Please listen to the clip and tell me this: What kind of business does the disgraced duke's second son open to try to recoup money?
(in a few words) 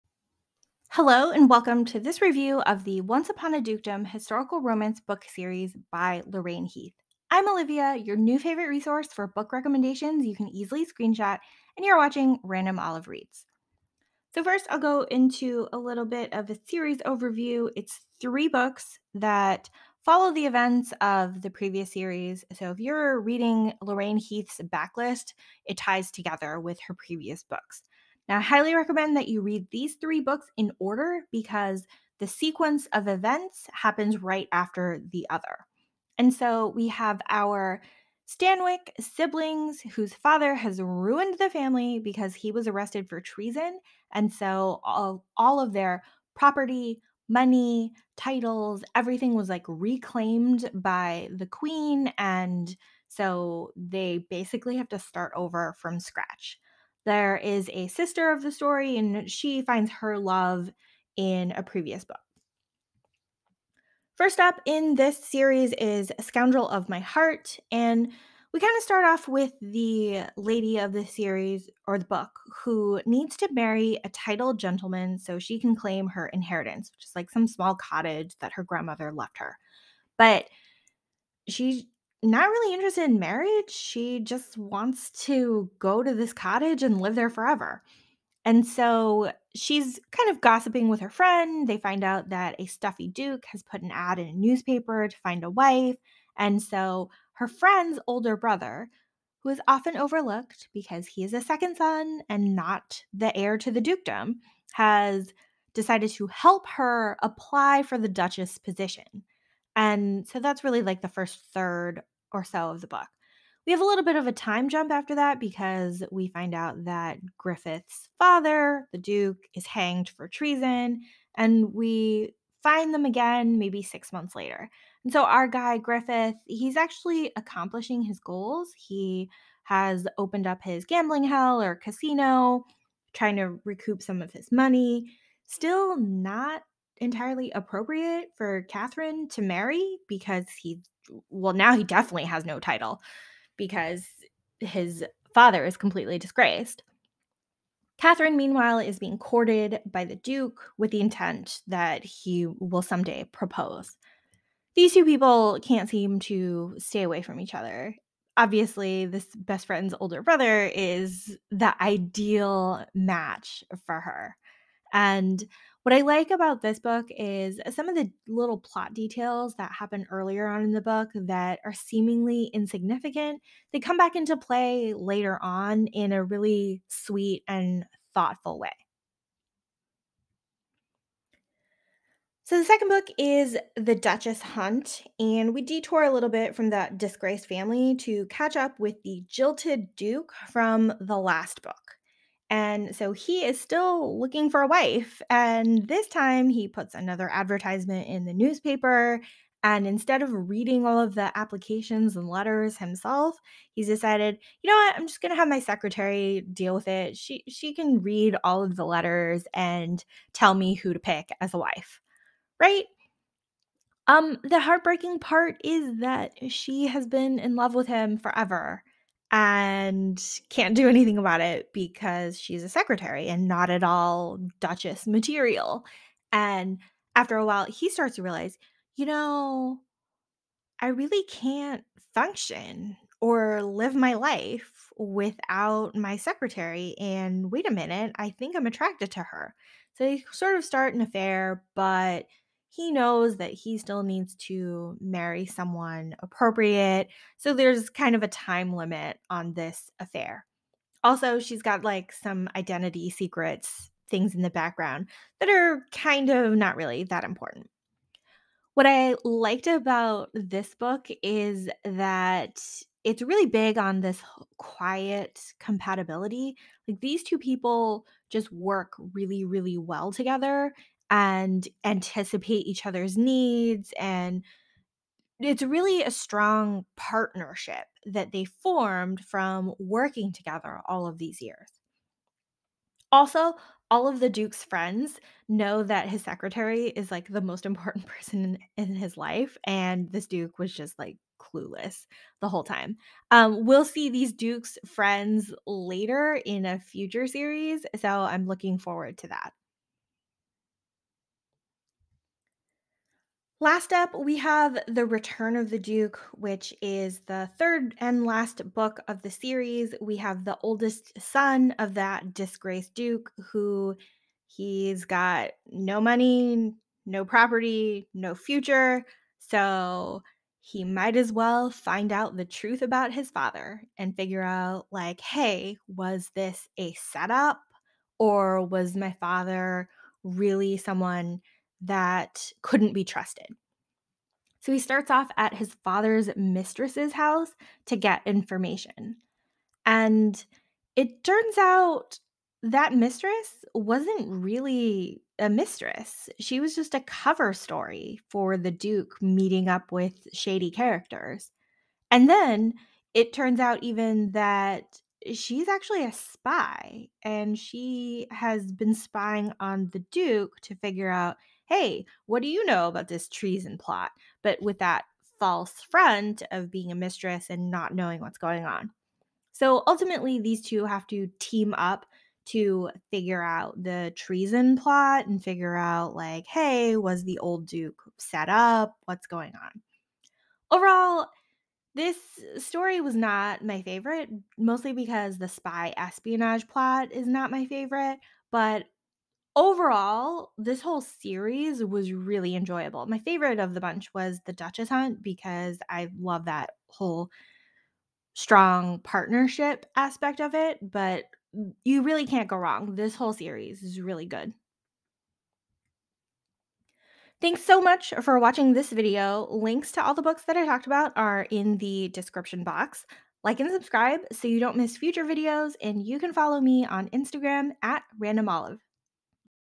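gambling hell.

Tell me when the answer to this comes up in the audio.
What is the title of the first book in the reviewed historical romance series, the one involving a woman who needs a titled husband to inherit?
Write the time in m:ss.
1:06.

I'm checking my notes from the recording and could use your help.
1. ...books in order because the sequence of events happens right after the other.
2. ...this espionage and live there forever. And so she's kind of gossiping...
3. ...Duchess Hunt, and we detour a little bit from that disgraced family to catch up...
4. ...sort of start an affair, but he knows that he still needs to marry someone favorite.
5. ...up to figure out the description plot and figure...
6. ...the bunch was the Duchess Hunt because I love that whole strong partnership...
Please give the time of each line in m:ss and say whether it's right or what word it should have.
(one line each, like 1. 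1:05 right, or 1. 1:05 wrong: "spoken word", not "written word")
1. 0:30 right
2. 1:26 wrong: "cottage", not "espionage"
3. 3:03 right
4. 4:00 wrong: "appropriate", not "favorite"
5. 6:11 wrong: "treason", not "description"
6. 6:33 right.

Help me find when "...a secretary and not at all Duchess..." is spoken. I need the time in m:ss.
3:42.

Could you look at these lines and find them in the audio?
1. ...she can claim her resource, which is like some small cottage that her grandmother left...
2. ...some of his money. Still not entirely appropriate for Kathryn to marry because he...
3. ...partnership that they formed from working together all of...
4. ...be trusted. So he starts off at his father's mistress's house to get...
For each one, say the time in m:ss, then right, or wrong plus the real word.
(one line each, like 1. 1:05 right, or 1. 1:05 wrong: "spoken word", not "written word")
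1. 1:15 wrong: "inheritance", not "resource"
2. 2:14 right
3. 4:36 right
4. 5:32 right.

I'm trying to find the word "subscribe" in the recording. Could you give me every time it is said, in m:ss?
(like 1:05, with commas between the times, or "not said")
6:53.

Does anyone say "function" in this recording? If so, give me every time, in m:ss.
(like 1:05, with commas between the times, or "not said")
3:52.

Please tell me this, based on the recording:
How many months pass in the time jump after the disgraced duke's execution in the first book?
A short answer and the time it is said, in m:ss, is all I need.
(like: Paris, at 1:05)
6, at 2:03.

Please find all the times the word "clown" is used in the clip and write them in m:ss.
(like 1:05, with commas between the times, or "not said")
not said.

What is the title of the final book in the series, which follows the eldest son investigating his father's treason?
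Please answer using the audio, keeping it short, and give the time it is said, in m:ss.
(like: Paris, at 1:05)
The Return of the Duke, at 5:04.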